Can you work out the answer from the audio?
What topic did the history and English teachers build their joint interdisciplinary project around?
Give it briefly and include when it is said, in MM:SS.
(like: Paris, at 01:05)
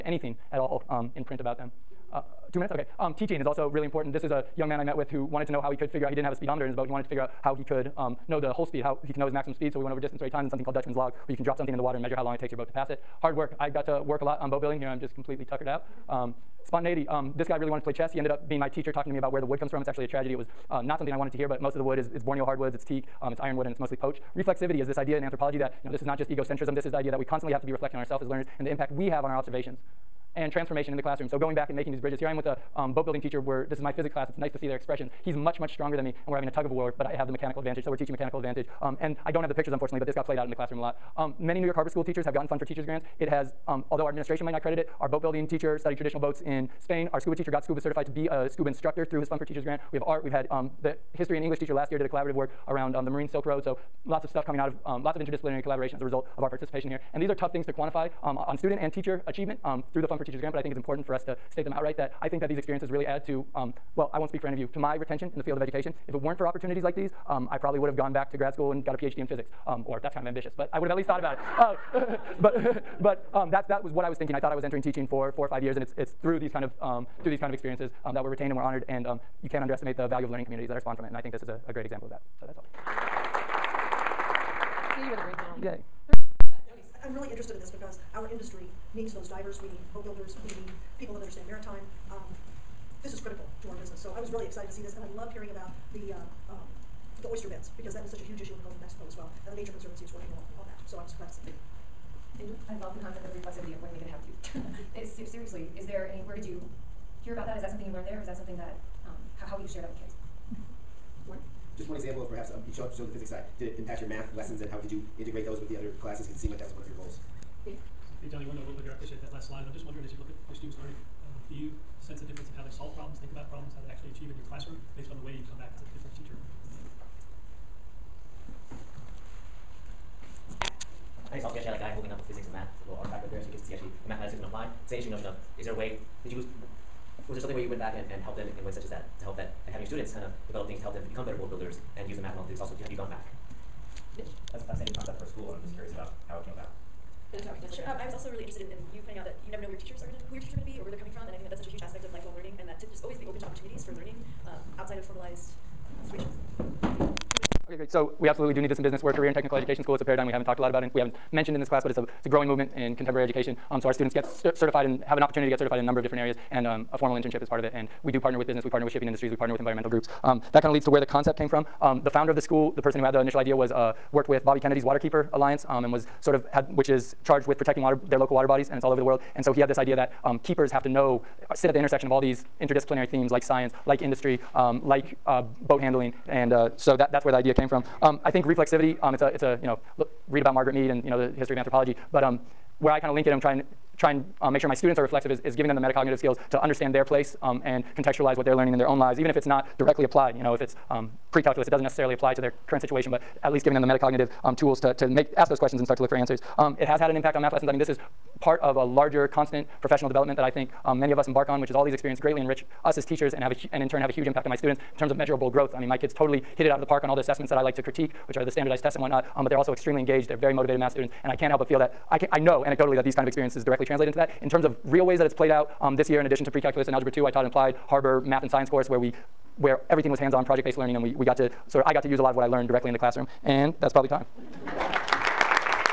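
Marine Silk Road, at 00:53.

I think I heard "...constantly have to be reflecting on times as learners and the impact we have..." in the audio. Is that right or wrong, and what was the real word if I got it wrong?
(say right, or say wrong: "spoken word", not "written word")
wrong: "ourselves", not "times".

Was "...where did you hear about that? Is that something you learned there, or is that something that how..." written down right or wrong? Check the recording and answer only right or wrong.
right.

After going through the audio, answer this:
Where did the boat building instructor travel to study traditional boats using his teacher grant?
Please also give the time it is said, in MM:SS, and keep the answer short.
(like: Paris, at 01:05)
Spain, at 00:46.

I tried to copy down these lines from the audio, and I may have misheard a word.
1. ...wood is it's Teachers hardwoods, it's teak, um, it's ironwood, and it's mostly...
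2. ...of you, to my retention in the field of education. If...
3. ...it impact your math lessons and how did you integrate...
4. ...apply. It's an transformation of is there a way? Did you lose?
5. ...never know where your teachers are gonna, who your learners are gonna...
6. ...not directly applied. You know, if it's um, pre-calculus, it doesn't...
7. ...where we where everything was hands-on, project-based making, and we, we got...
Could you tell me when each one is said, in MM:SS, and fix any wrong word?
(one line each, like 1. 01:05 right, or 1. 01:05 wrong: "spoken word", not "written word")
1. 00:21 wrong: "Borneo", not "Teachers"
2. 01:04 right
3. 01:53 right
4. 02:14 wrong: "notion", not "transformation"
5. 02:29 wrong: "teachers", not "learners"
6. 03:19 right
7. 03:48 wrong: "learning", not "making".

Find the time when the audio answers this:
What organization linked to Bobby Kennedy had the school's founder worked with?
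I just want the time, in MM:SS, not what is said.
02:54.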